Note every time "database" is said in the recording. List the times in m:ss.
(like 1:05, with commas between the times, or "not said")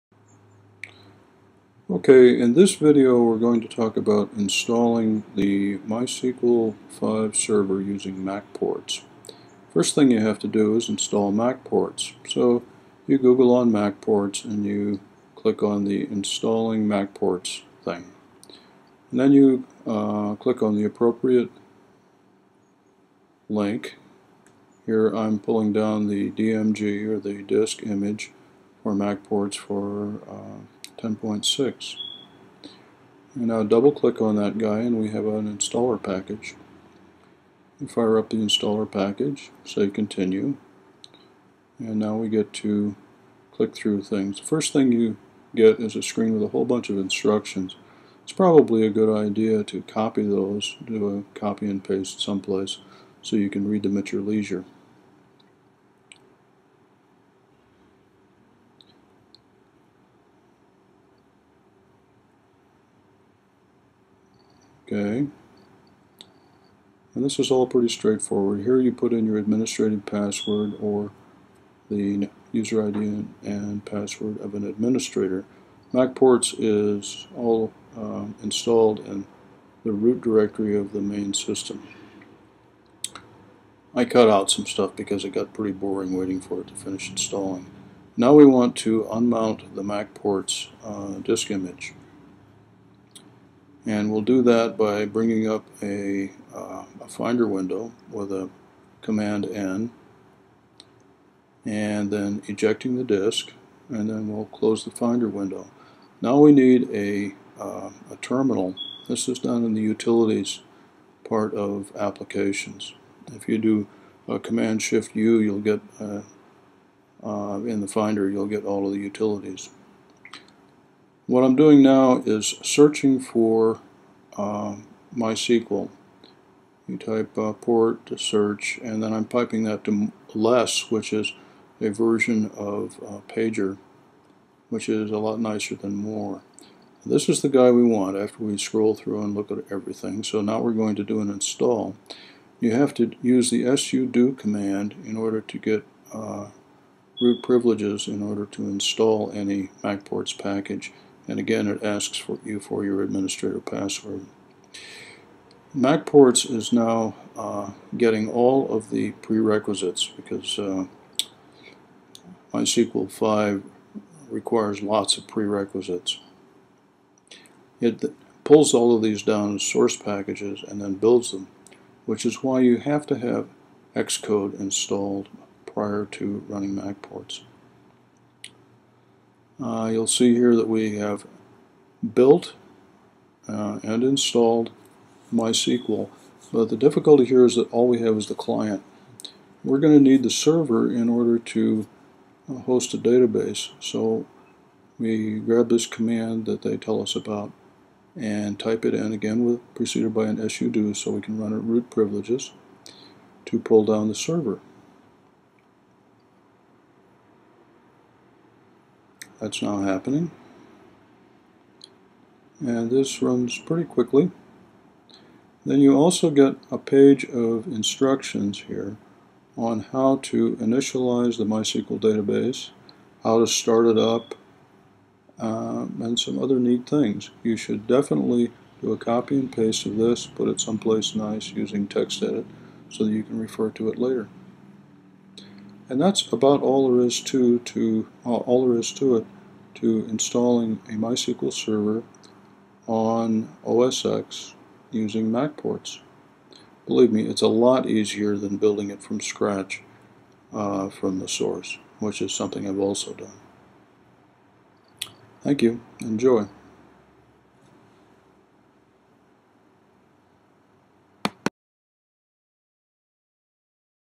3:12, 3:41.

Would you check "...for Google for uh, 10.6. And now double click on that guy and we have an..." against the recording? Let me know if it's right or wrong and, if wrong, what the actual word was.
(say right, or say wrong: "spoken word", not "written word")
wrong: "MacPorts", not "Google".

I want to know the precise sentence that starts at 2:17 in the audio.
This is the guy we want after we scroll through and look at everything.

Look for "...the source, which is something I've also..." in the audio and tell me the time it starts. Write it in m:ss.
4:11.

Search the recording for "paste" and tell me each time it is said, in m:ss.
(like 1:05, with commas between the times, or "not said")
0:51, 3:49.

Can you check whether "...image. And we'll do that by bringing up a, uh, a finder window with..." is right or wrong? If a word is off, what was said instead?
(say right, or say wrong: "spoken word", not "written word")
right.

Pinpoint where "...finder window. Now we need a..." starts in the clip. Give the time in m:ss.
1:44.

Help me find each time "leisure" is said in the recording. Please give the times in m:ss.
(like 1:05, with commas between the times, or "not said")
0:54.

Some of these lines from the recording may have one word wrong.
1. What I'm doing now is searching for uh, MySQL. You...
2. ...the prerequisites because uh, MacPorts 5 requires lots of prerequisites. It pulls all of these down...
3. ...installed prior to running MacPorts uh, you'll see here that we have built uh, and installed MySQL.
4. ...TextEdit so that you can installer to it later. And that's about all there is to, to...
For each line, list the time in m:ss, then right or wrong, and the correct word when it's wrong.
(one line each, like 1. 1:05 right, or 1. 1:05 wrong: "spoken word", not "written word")
1. 2:01 right
2. 2:38 wrong: "MySQL", not "MacPorts"
3. 2:54 right
4. 3:51 wrong: "refer", not "installer".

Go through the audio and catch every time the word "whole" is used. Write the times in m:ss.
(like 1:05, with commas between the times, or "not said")
0:46.